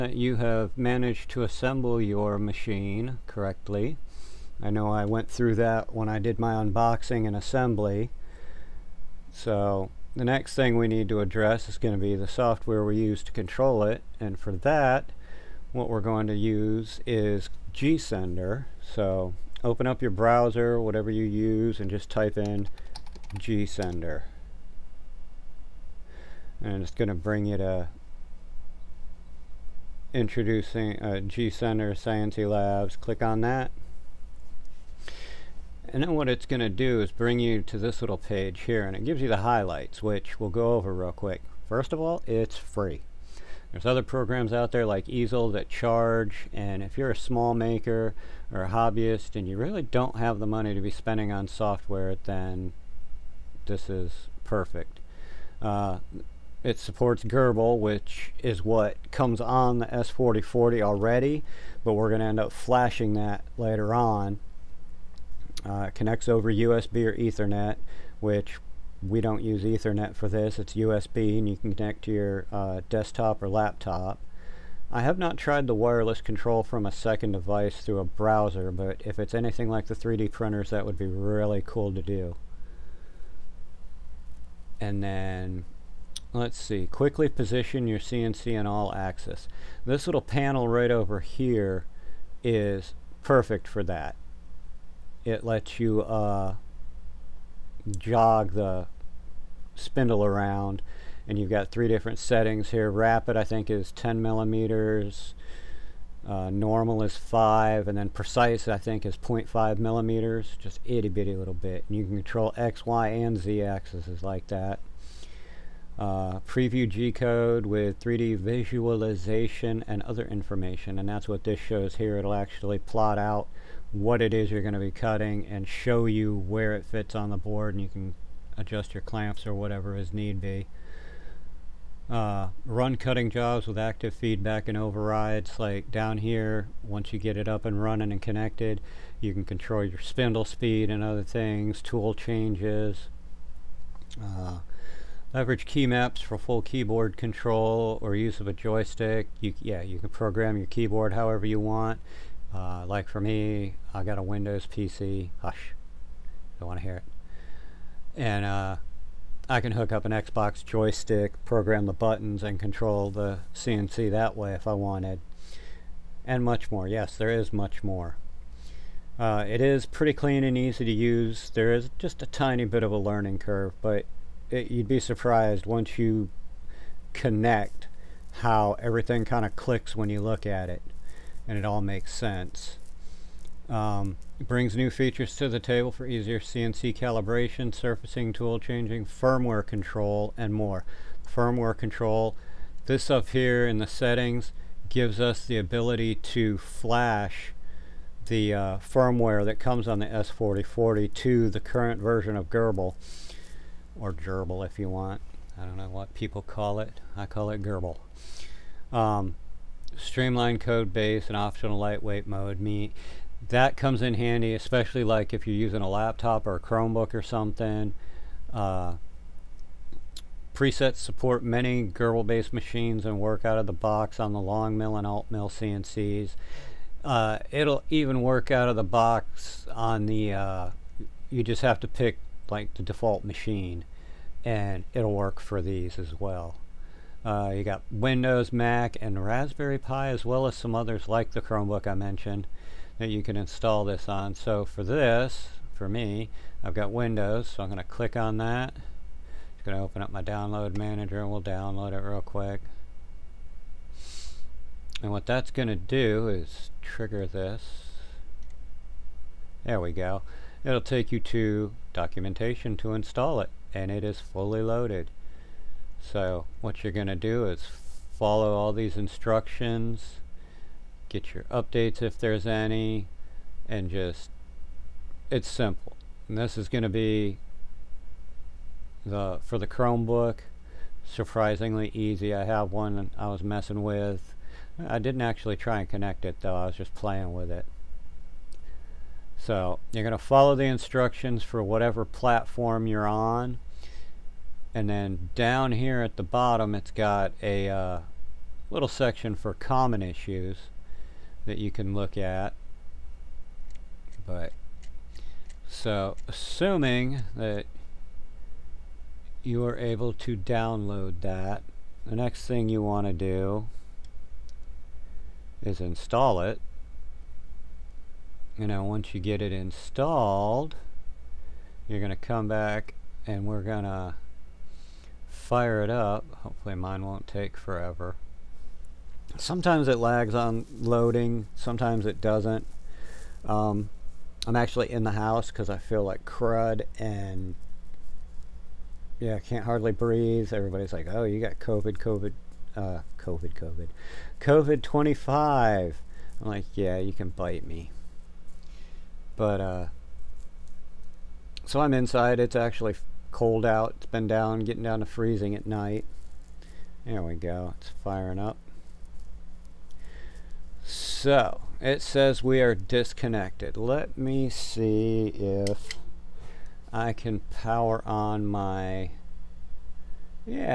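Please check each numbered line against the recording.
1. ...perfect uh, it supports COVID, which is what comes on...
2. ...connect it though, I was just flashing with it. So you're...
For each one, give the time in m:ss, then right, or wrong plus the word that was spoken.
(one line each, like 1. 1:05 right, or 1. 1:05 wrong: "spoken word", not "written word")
1. 0:54 wrong: "Gerbil", not "COVID"
2. 4:45 wrong: "playing", not "flashing".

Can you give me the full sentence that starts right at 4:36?
And this is going to be the for the Chromebook, surprisingly easy.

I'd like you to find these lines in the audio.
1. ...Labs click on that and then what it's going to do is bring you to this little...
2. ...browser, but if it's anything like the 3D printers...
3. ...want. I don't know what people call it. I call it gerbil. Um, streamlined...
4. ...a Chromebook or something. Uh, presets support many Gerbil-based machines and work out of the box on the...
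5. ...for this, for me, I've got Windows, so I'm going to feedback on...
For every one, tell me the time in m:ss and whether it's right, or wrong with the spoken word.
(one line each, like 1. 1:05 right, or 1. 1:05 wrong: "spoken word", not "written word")
1. 0:32 right
2. 1:18 right
3. 3:24 right
4. 3:36 right
5. 4:04 wrong: "click", not "feedback".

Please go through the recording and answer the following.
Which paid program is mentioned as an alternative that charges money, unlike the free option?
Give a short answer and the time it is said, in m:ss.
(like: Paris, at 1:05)
Easel, at 0:45.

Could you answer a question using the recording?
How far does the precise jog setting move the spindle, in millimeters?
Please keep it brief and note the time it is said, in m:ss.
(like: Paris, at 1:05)
0.5 millimeters, at 1:49.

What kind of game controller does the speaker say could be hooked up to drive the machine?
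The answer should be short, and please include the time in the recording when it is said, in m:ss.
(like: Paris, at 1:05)
Xbox joystick, at 2:40.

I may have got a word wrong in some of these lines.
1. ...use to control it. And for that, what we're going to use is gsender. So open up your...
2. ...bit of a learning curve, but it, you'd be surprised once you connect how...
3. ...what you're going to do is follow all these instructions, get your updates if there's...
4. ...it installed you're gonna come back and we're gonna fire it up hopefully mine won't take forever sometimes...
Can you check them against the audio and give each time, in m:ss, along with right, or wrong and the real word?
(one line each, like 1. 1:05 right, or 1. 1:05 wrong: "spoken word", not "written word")
1. 0:12 right
2. 2:52 right
3. 4:26 right
4. 5:19 right.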